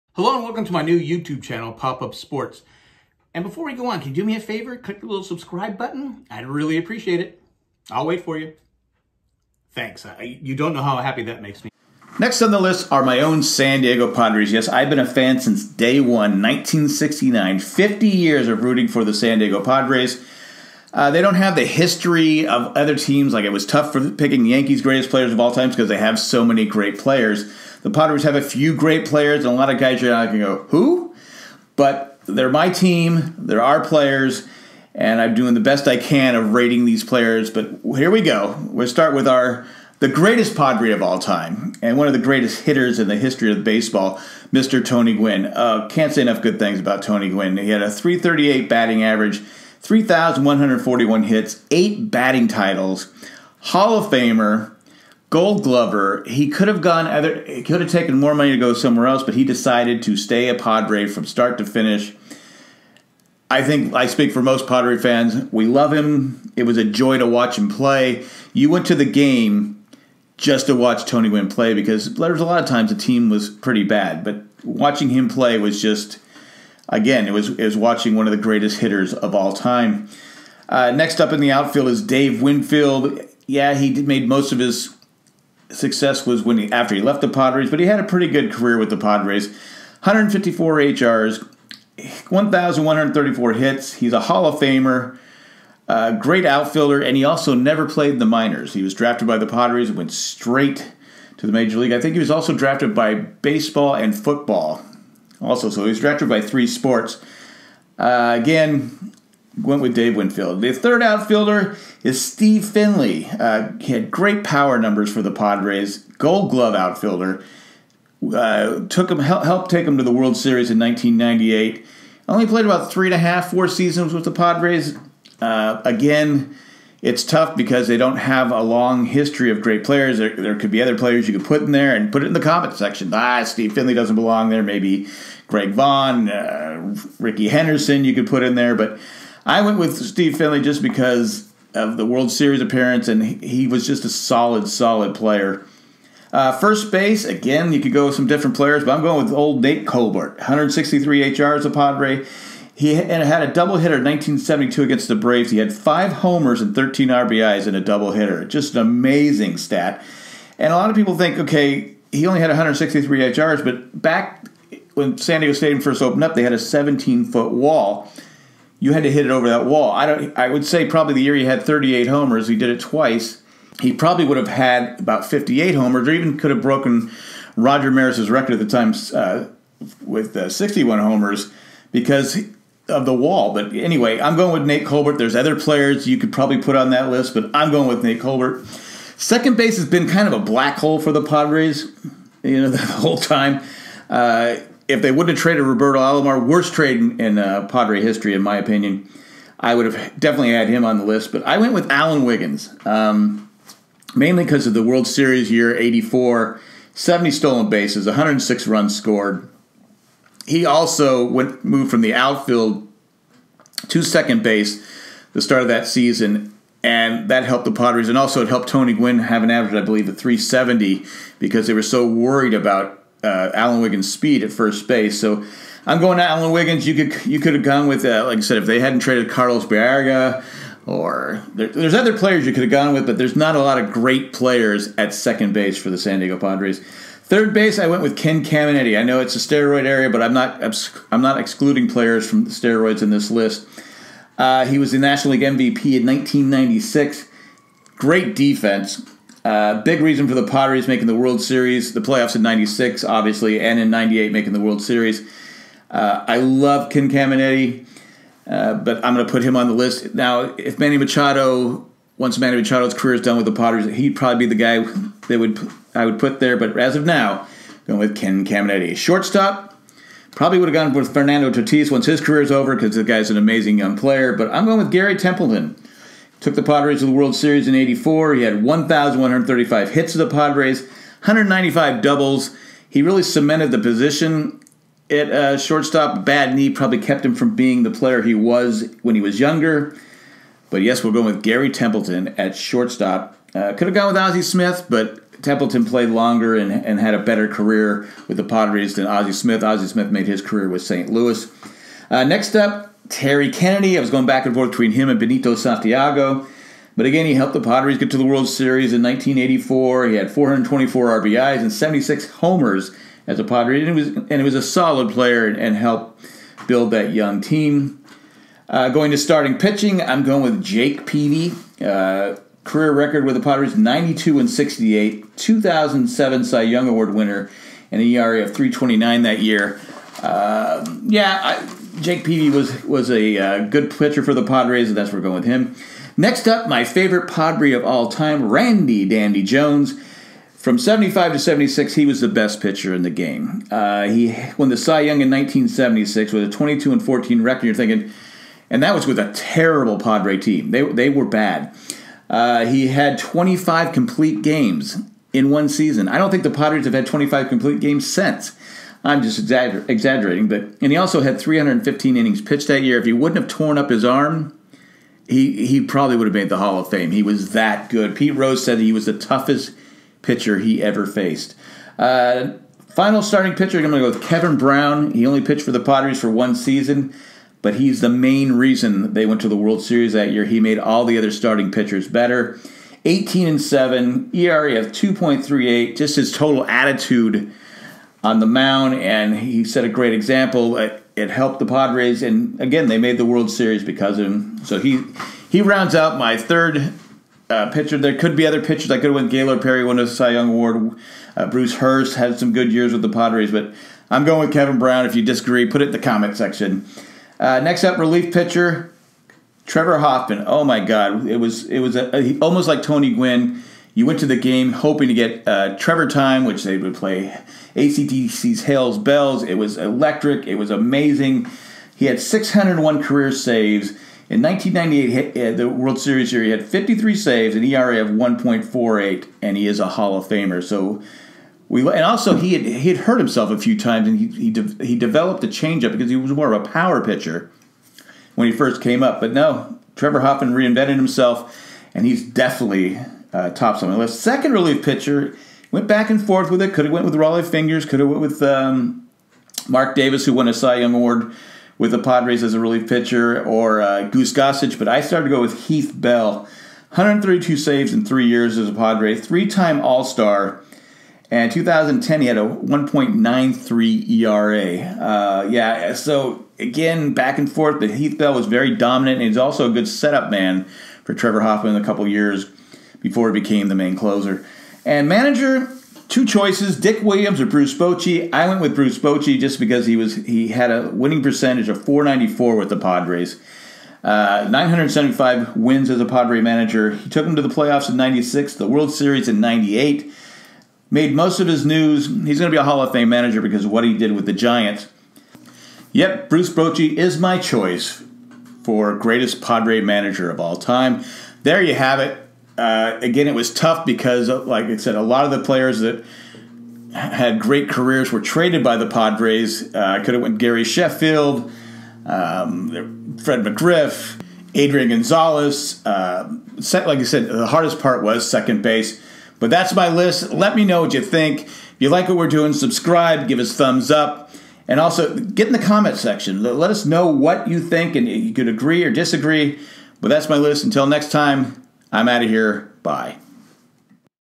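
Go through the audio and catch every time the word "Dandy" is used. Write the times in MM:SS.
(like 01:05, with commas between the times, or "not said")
05:39.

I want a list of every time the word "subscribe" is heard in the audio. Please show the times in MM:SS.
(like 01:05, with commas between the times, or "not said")
00:05, 08:42.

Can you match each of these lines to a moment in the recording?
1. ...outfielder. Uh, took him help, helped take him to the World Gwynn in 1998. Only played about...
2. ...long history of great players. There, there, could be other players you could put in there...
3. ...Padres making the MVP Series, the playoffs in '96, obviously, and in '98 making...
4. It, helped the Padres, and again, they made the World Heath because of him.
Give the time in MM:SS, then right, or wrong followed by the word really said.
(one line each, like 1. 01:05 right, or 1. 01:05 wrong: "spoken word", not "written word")
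1. 01:56 wrong: "Series", not "Gwynn"
2. 02:08 right
3. 04:10 wrong: "World", not "MVP"
4. 06:30 wrong: "Series", not "Heath".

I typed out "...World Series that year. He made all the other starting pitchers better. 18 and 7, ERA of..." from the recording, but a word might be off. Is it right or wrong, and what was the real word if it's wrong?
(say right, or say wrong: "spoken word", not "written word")
right.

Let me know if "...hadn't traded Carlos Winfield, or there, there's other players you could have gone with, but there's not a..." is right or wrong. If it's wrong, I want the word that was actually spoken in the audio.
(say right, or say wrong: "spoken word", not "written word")
wrong: "Baerga", not "Winfield".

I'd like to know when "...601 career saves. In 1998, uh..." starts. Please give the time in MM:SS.
07:02.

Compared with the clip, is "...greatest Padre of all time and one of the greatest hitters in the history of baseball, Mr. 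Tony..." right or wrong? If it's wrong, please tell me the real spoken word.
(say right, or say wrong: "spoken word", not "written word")
right.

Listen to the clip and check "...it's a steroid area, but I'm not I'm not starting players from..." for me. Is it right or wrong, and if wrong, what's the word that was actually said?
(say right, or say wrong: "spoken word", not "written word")
wrong: "excluding", not "starting".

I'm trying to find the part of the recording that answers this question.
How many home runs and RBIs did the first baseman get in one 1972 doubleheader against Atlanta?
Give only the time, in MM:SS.
02:35.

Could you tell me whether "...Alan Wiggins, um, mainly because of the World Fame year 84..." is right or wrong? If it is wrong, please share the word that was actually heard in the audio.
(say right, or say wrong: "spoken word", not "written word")
wrong: "Series", not "Fame".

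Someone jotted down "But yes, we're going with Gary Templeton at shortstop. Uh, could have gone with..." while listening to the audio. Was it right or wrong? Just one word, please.
right.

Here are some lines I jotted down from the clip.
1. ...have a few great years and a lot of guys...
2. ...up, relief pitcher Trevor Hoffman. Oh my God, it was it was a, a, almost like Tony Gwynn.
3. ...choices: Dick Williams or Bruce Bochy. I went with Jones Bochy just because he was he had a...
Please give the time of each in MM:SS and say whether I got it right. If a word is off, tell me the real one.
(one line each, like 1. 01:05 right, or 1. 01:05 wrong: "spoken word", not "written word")
1. 00:28 wrong: "players", not "years"
2. 06:47 right
3. 07:56 wrong: "Bruce", not "Jones".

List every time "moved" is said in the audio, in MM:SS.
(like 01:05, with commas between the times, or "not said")
03:31.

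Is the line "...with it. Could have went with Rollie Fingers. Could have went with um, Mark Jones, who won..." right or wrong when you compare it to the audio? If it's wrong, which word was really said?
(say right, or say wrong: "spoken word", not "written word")
wrong: "Davis", not "Jones".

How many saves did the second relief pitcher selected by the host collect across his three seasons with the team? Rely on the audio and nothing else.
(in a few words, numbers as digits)
132.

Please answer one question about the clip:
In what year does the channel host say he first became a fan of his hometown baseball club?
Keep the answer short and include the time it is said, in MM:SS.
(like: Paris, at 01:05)
1969, at 00:16.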